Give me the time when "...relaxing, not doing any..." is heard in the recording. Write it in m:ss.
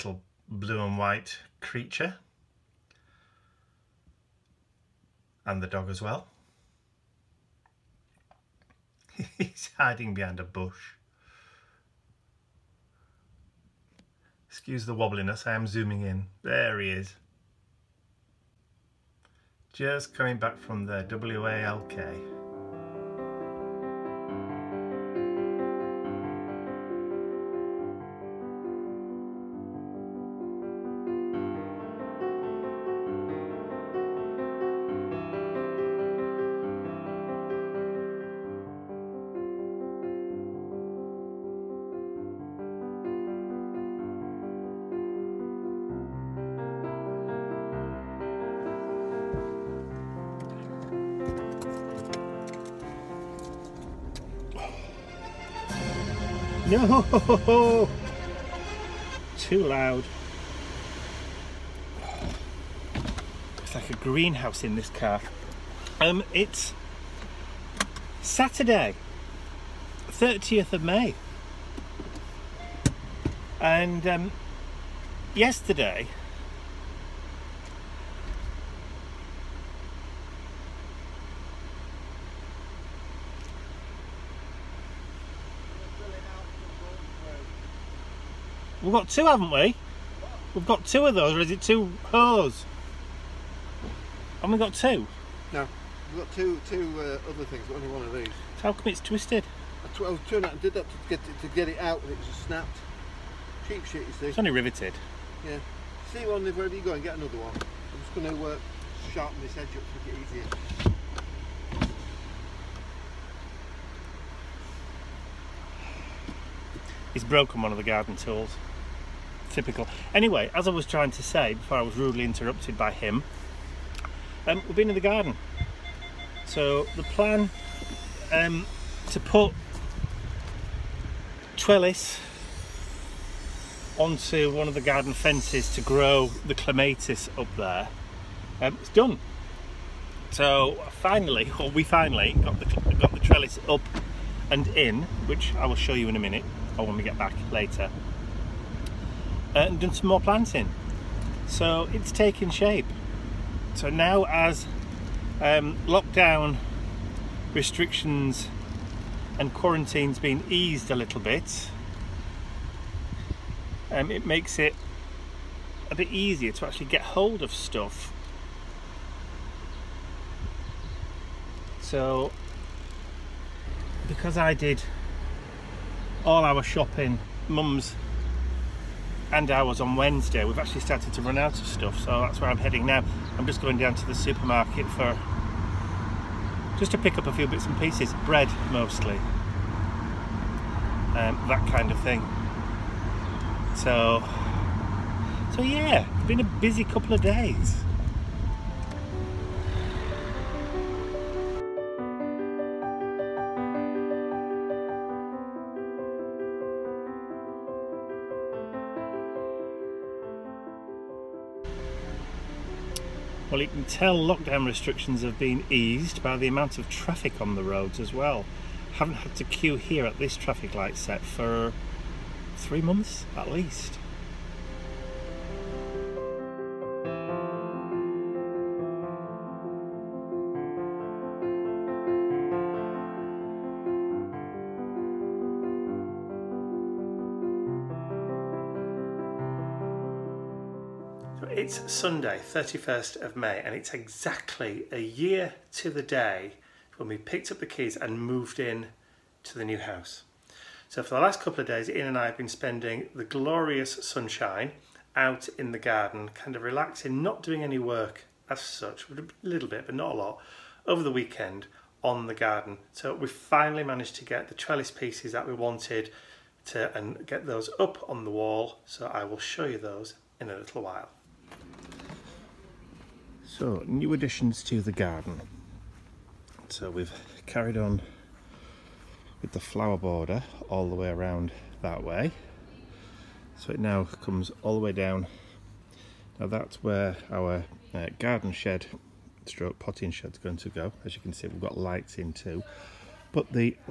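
4:16.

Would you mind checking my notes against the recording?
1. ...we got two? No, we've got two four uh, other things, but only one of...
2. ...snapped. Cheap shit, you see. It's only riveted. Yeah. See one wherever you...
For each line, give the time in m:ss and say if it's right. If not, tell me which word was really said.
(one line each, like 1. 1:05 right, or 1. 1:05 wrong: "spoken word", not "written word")
1. 1:34 wrong: "two", not "four"
2. 1:42 right.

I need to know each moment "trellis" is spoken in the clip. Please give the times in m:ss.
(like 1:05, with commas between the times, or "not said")
2:11, 2:23, 4:24.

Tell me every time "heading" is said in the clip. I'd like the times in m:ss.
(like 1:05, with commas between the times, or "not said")
3:02.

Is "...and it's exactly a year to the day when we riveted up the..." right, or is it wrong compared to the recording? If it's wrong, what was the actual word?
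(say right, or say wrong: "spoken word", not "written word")
wrong: "picked", not "riveted".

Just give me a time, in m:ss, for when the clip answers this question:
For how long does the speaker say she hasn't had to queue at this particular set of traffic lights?
3:42.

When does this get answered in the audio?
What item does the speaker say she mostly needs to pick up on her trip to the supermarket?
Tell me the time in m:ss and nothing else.
3:08.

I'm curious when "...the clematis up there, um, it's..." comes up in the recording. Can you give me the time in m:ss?
2:16.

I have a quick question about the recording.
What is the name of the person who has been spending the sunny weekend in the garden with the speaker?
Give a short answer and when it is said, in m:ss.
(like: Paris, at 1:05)
Ian, at 4:11.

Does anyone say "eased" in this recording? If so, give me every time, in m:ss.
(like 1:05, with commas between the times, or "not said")
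2:40, 3:35.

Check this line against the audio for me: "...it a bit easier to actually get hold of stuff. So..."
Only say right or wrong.
right.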